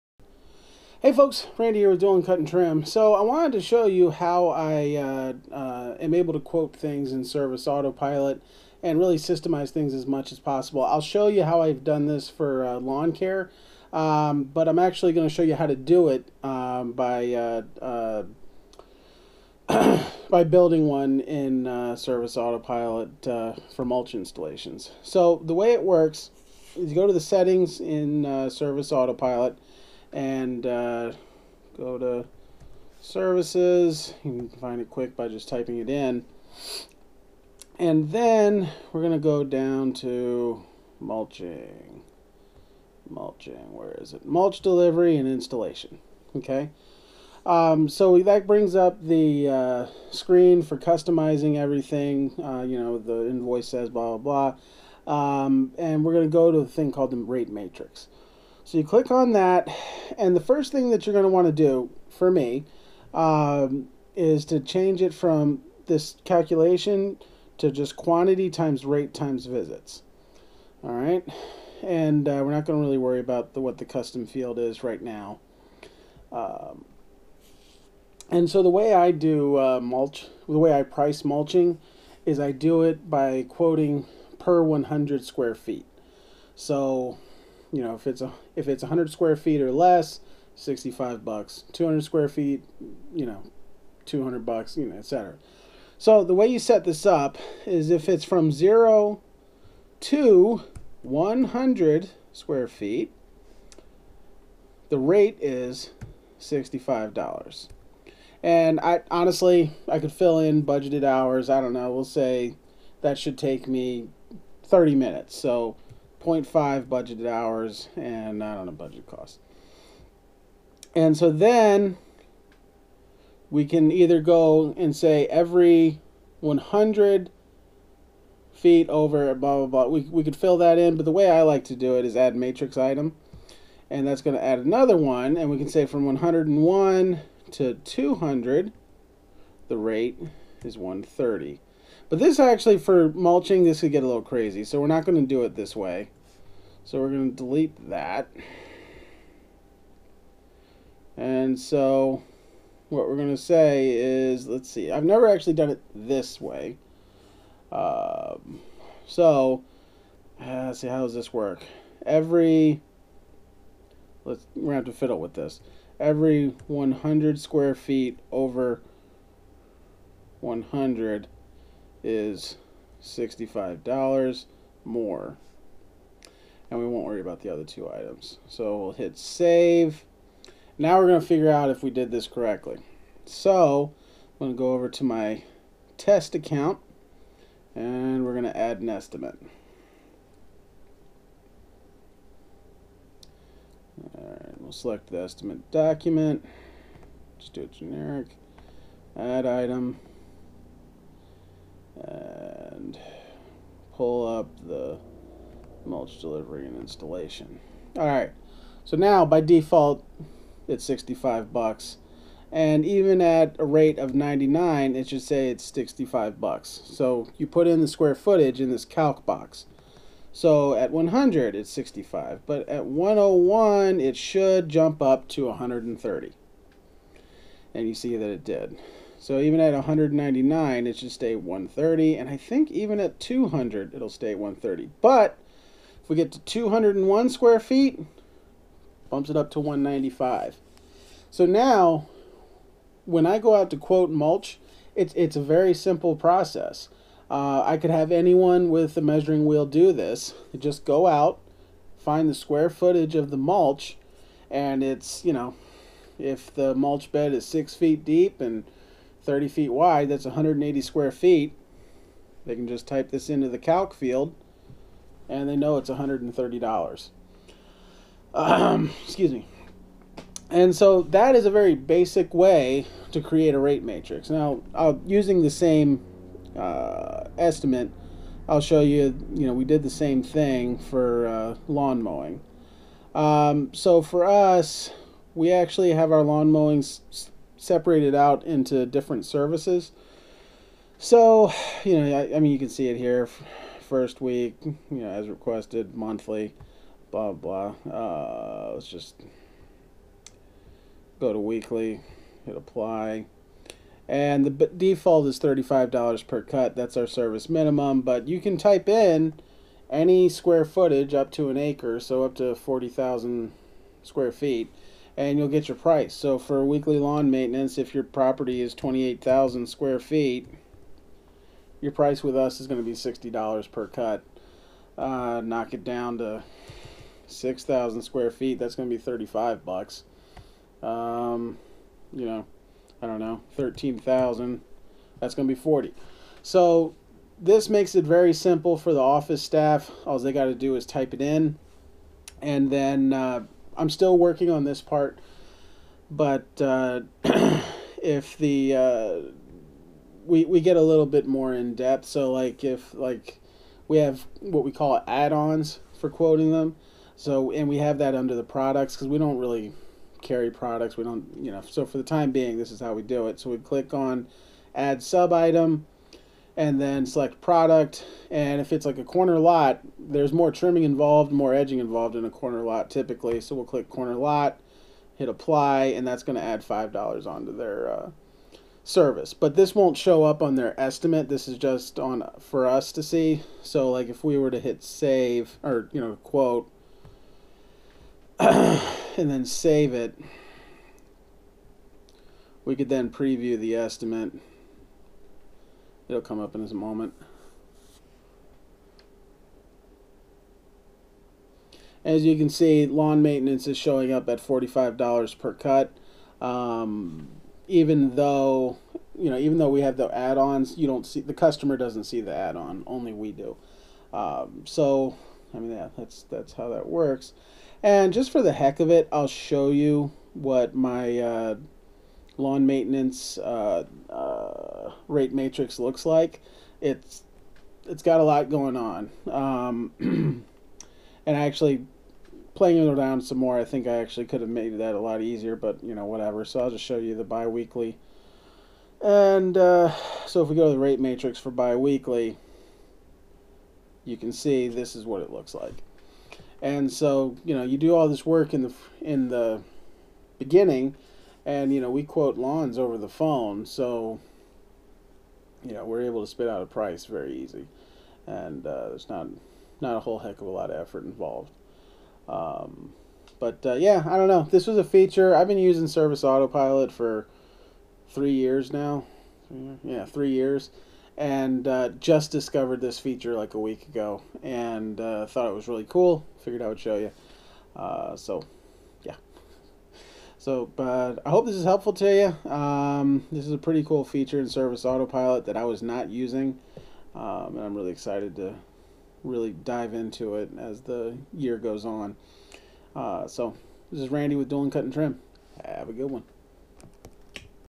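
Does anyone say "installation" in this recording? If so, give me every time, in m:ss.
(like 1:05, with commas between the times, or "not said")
0:24, 0:45, 3:26.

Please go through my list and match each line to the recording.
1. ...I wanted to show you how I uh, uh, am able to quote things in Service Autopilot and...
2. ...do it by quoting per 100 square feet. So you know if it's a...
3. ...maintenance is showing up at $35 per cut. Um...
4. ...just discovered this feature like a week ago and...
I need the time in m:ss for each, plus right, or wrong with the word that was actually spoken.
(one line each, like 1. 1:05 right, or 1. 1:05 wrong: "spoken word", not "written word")
1. 0:03 right
2. 1:22 right
3. 6:43 wrong: "45", not "35"
4. 7:51 right.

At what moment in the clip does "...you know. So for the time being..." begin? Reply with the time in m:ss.
6:01.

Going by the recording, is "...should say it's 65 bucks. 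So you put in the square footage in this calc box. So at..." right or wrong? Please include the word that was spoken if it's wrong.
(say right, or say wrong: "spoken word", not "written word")
right.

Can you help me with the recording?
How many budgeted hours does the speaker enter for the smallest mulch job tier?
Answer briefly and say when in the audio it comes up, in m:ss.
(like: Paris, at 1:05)
0.5, at 1:56.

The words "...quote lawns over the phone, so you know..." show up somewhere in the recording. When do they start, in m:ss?
7:32.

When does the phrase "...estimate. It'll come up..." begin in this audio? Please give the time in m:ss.
6:33.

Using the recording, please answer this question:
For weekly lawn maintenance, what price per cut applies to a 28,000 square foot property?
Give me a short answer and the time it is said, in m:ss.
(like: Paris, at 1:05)
$60, at 5:22.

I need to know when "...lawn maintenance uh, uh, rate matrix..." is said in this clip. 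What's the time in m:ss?
7:02.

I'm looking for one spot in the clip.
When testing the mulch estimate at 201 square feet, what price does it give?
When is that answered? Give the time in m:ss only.
3:59.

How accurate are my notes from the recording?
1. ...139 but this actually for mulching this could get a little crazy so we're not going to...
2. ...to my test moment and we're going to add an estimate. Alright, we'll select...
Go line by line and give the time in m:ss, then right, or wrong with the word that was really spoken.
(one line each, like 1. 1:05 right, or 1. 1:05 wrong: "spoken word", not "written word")
1. 2:20 wrong: "130", not "139"
2. 3:04 wrong: "account", not "moment".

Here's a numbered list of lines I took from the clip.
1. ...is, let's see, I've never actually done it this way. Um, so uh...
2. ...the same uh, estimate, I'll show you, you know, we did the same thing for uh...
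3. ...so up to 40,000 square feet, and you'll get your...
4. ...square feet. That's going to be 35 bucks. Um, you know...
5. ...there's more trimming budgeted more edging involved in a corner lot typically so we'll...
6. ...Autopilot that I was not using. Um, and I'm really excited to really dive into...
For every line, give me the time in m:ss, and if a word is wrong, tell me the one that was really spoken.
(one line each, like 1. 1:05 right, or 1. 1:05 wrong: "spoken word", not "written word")
1. 2:33 right
2. 4:35 right
3. 5:11 right
4. 5:28 right
5. 6:09 wrong: "involved", not "budgeted"
6. 8:04 right.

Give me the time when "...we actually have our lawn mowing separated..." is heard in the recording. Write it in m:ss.
4:45.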